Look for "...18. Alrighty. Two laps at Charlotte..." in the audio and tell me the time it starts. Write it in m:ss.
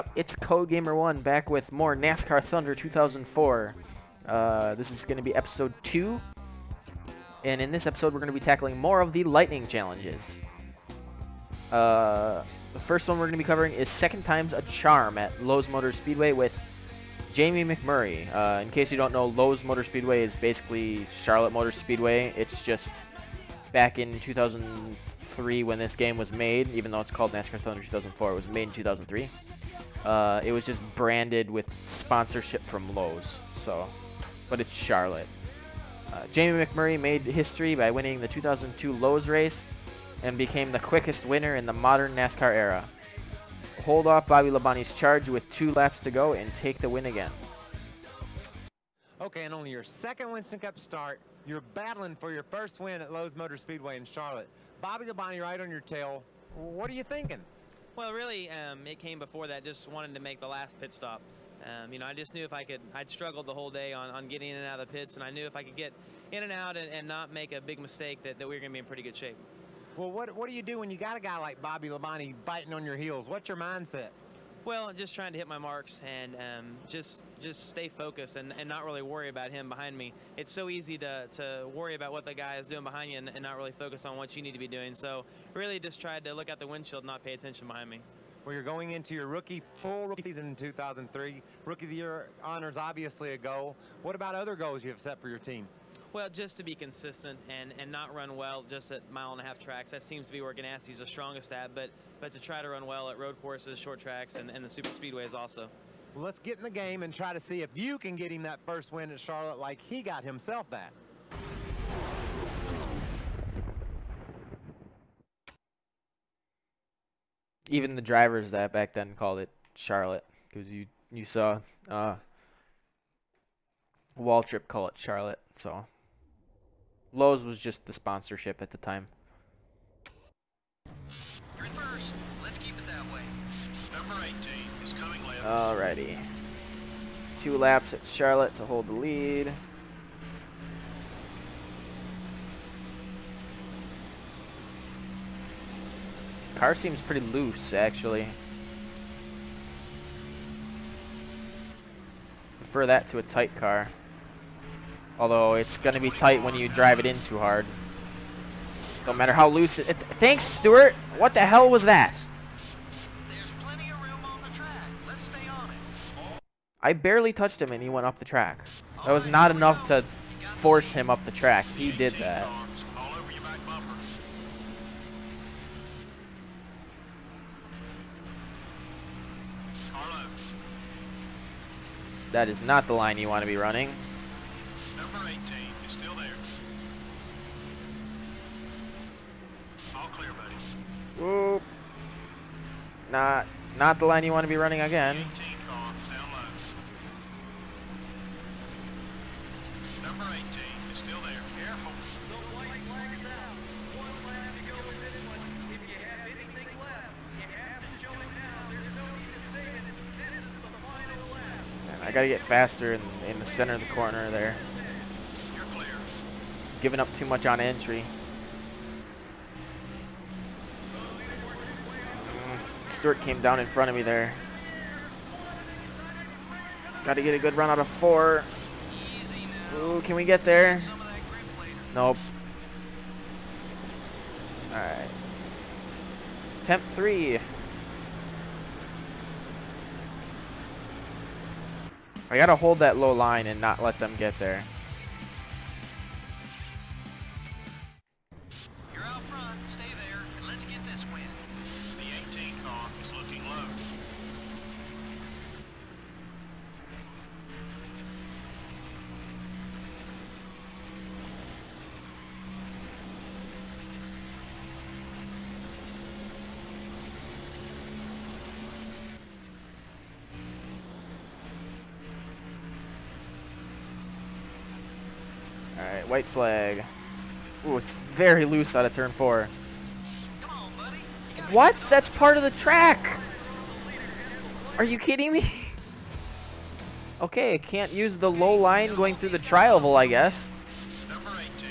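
2:14.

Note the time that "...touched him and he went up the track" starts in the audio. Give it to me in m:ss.
2:47.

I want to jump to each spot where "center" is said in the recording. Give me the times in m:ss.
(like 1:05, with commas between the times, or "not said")
3:33.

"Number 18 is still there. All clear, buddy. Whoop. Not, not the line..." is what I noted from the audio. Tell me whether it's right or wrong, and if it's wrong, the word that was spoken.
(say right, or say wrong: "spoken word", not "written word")
right.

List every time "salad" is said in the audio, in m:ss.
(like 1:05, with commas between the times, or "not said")
not said.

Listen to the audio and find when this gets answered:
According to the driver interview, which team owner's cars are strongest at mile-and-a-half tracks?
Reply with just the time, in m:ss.
1:40.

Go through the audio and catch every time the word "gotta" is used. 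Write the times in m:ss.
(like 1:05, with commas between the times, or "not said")
3:32, 3:47, 4:02.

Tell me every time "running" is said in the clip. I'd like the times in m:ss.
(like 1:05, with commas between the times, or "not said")
3:03, 3:14.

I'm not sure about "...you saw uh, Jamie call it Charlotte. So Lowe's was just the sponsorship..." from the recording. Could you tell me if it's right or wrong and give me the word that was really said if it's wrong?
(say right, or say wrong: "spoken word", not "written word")
wrong: "Trip", not "Jamie".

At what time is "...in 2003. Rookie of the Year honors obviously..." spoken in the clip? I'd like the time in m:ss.
1:30.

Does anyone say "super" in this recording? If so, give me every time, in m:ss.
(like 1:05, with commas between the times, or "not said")
1:44.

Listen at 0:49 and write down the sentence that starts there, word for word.
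Okay, and only your second Winston Cup start, you're battling for your first win at Lowe's Motor Speedway in Charlotte.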